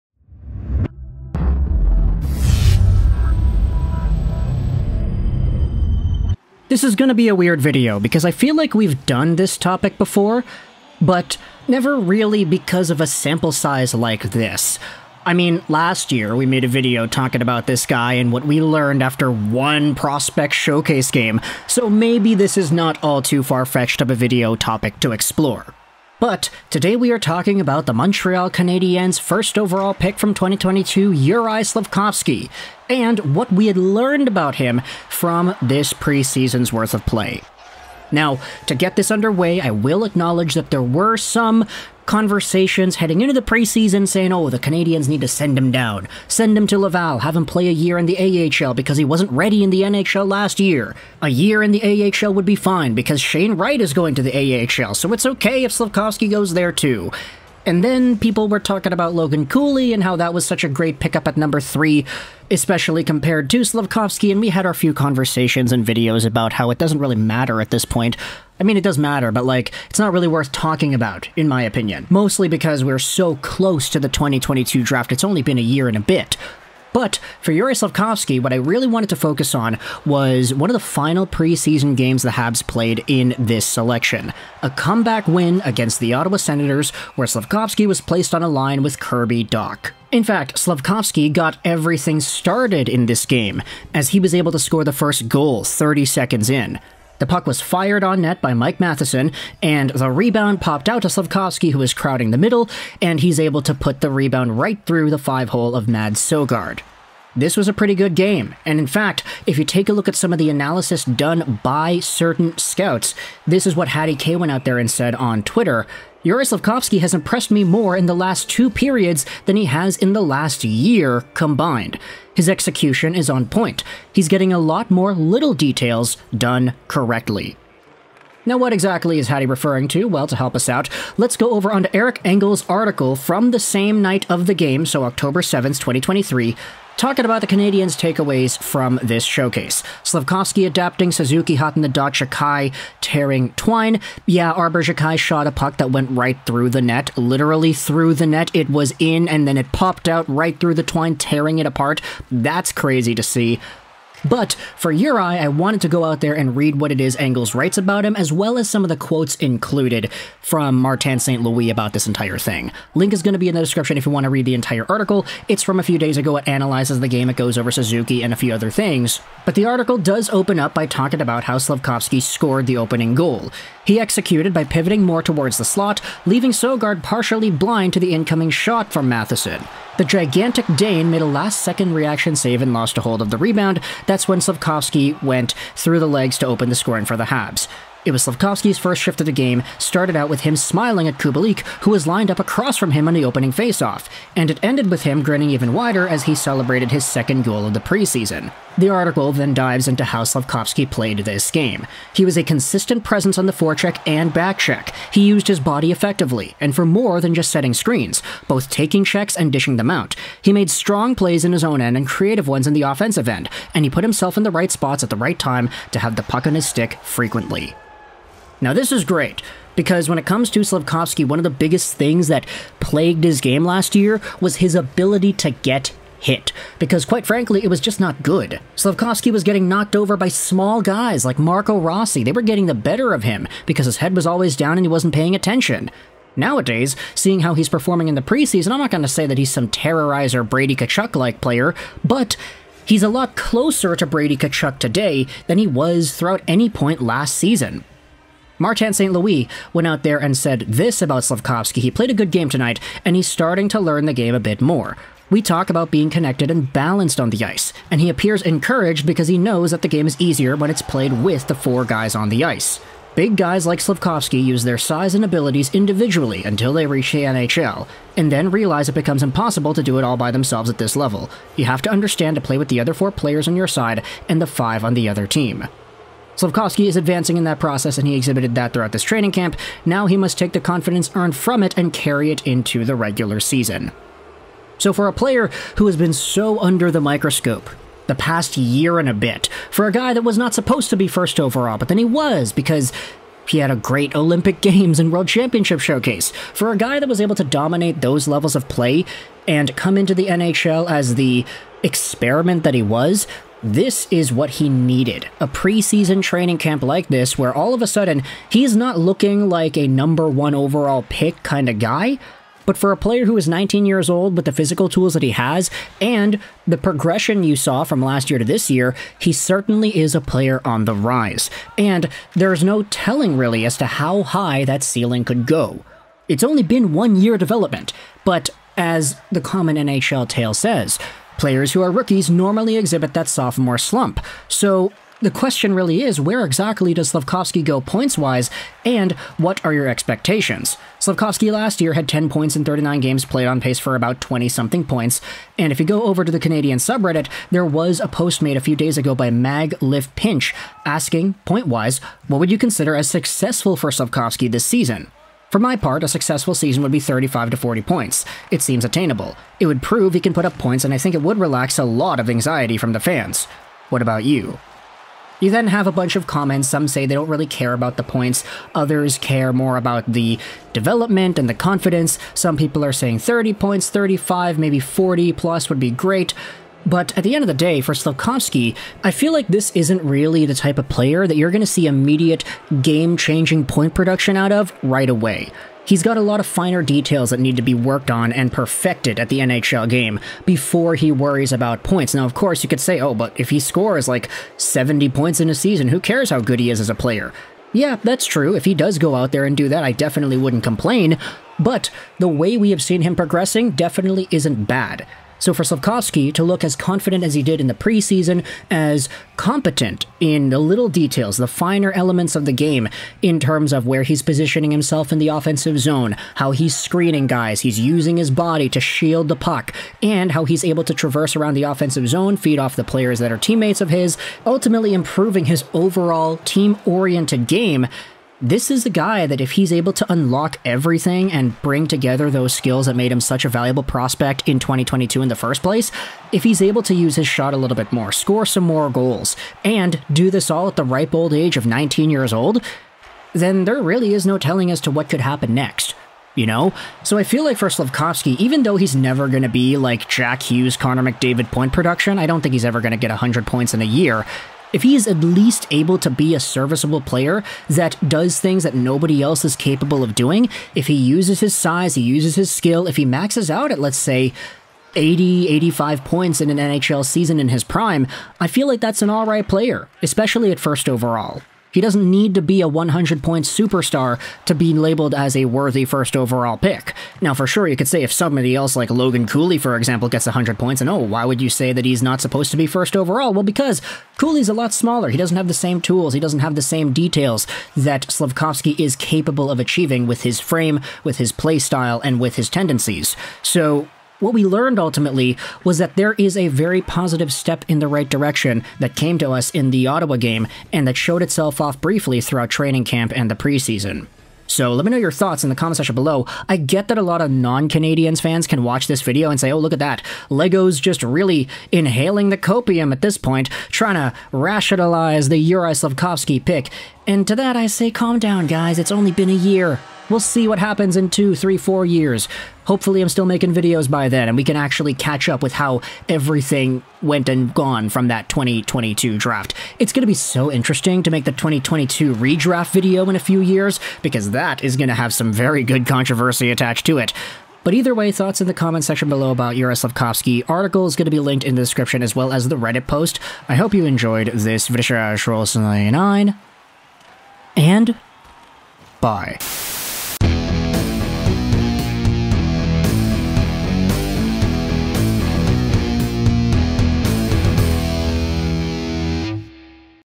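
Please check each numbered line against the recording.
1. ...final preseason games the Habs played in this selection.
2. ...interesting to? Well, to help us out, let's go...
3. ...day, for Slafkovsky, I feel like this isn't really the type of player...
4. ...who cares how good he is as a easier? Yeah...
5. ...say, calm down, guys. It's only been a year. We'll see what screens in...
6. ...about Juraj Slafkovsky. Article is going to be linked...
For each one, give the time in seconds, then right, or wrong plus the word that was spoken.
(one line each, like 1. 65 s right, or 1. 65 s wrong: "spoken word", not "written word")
1. 80 s right
2. 129 s wrong: "referring", not "interesting"
3. 377 s right
4. 395 s wrong: "player", not "easier"
5. 517 s wrong: "happens", not "screens"
6. 539 s right.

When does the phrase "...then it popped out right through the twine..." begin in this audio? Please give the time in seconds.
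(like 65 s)
149 s.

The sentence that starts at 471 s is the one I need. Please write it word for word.
He doesn't need to be a 100 point superstar to be labeled as a worthy first overall pick.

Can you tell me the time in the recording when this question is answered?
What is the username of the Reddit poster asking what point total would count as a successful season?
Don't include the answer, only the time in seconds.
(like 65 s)
349 s.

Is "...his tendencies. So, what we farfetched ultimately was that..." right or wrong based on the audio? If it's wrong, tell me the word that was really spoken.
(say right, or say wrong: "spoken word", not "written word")
wrong: "learned", not "farfetched".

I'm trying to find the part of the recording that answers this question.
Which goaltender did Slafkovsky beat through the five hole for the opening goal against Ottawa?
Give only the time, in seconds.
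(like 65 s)
105 s.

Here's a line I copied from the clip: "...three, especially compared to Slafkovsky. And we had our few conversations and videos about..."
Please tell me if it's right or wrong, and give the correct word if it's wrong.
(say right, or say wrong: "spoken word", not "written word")
right.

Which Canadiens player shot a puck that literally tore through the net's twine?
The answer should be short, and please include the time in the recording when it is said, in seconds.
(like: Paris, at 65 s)
Arber Xhekaj, at 144 s.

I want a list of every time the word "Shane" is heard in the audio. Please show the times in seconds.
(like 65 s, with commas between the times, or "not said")
53 s.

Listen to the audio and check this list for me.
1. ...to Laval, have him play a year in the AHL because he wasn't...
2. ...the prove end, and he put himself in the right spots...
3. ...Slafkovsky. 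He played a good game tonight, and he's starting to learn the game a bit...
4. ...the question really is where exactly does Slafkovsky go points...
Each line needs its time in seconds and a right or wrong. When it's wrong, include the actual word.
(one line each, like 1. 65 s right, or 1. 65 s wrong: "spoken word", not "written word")
1. 46 s right
2. 212 s wrong: "offensive", not "prove"
3. 251 s right
4. 335 s right.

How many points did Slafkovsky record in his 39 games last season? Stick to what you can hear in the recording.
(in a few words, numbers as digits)
10.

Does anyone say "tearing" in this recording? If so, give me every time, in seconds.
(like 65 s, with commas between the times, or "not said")
143 s, 151 s.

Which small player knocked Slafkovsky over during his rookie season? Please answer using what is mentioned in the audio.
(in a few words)
Marco Rossi.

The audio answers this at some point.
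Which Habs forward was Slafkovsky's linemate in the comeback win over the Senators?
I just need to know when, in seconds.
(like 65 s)
88 s.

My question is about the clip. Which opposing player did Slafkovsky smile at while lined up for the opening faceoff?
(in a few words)
Kubalik.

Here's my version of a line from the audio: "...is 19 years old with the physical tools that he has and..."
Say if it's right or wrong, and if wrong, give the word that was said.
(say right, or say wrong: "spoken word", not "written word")
right.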